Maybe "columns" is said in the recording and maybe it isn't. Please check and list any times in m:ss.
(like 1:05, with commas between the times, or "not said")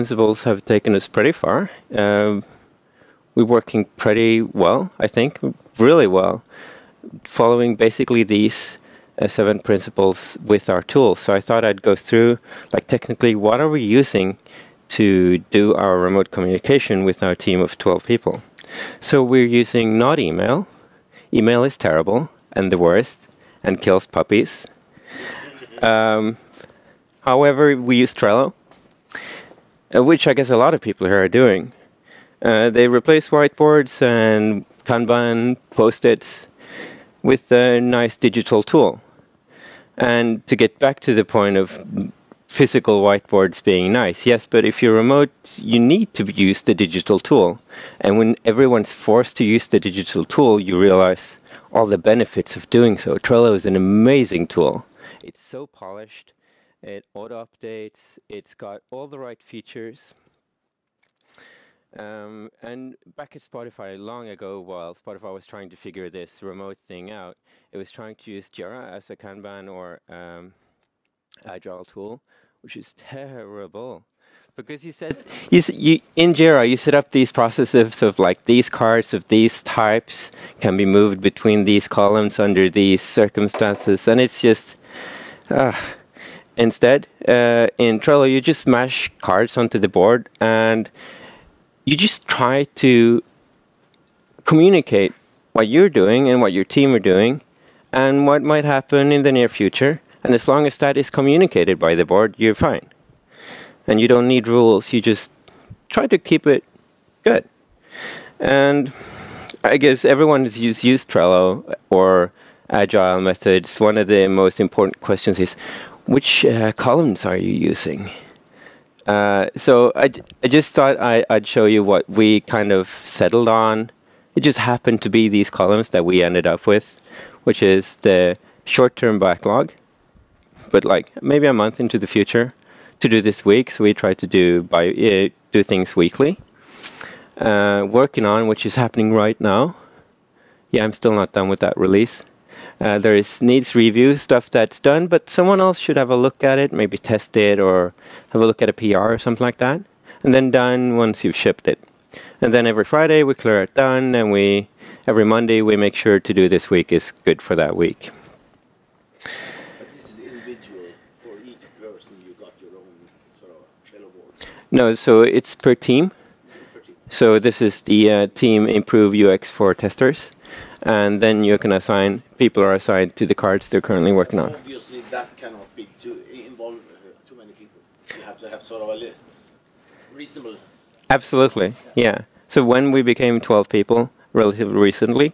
1:21, 1:56, 2:05.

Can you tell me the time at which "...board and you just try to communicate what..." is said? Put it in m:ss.
1:29.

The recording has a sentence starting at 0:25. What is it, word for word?
Um, however, we use Trello, uh, which I guess a lot of people here are doing.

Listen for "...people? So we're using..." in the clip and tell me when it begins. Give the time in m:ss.
0:18.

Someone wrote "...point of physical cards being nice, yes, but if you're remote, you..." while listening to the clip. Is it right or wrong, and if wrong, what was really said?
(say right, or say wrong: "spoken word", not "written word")
wrong: "whiteboards", not "cards".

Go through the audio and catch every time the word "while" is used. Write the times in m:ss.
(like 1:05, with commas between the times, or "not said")
1:04.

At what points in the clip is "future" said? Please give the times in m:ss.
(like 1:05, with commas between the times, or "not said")
1:39, 2:12.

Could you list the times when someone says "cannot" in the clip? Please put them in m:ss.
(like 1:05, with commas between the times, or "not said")
2:55.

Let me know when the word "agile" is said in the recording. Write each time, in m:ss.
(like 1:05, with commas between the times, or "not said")
1:11, 1:52.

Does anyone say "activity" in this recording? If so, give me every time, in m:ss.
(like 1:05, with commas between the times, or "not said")
not said.